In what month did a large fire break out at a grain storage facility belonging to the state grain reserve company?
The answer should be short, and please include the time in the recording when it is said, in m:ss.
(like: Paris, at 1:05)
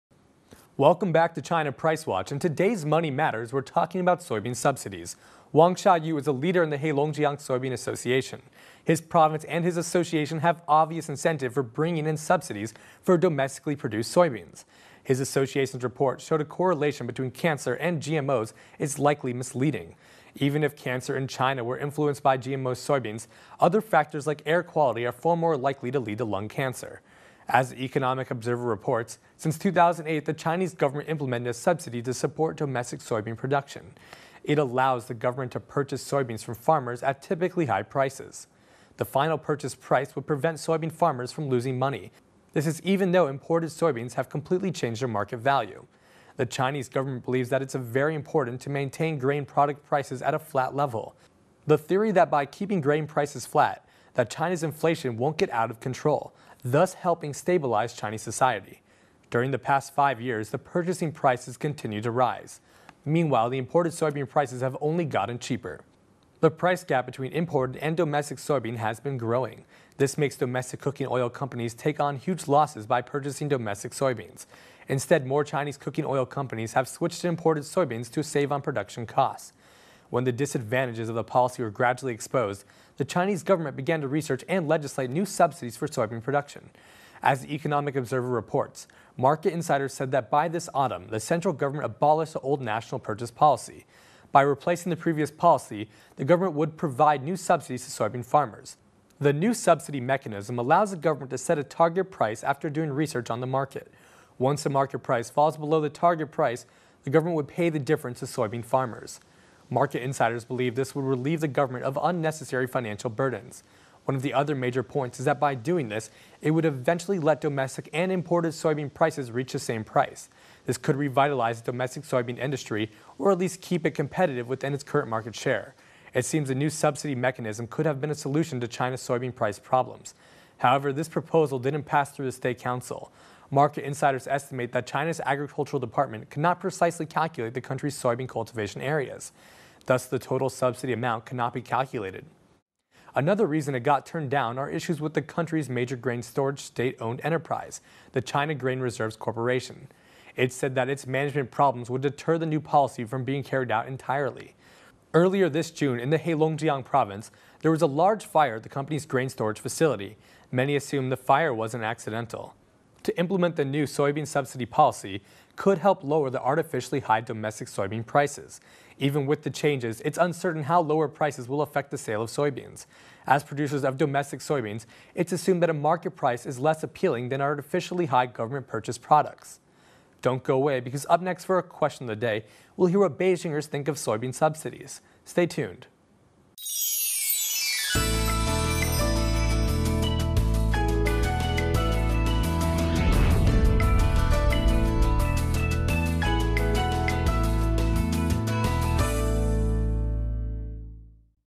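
June, at 2:35.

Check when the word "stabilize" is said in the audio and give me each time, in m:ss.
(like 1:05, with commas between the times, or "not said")
0:57.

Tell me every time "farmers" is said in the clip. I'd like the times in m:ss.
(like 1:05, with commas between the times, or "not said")
0:36, 0:40, 1:38, 1:48.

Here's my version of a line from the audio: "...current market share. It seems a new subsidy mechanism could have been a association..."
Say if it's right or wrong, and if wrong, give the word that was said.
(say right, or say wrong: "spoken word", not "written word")
wrong: "solution", not "association".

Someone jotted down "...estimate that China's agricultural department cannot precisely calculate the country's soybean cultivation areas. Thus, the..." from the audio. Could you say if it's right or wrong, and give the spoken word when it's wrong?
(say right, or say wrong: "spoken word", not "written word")
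right.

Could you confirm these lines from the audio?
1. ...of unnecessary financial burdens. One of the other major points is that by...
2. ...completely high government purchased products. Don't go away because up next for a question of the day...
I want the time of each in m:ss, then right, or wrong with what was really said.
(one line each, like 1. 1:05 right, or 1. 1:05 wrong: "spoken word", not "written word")
1. 1:51 right
2. 2:57 wrong: "artificially", not "completely".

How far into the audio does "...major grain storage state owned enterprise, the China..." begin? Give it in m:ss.
2:25.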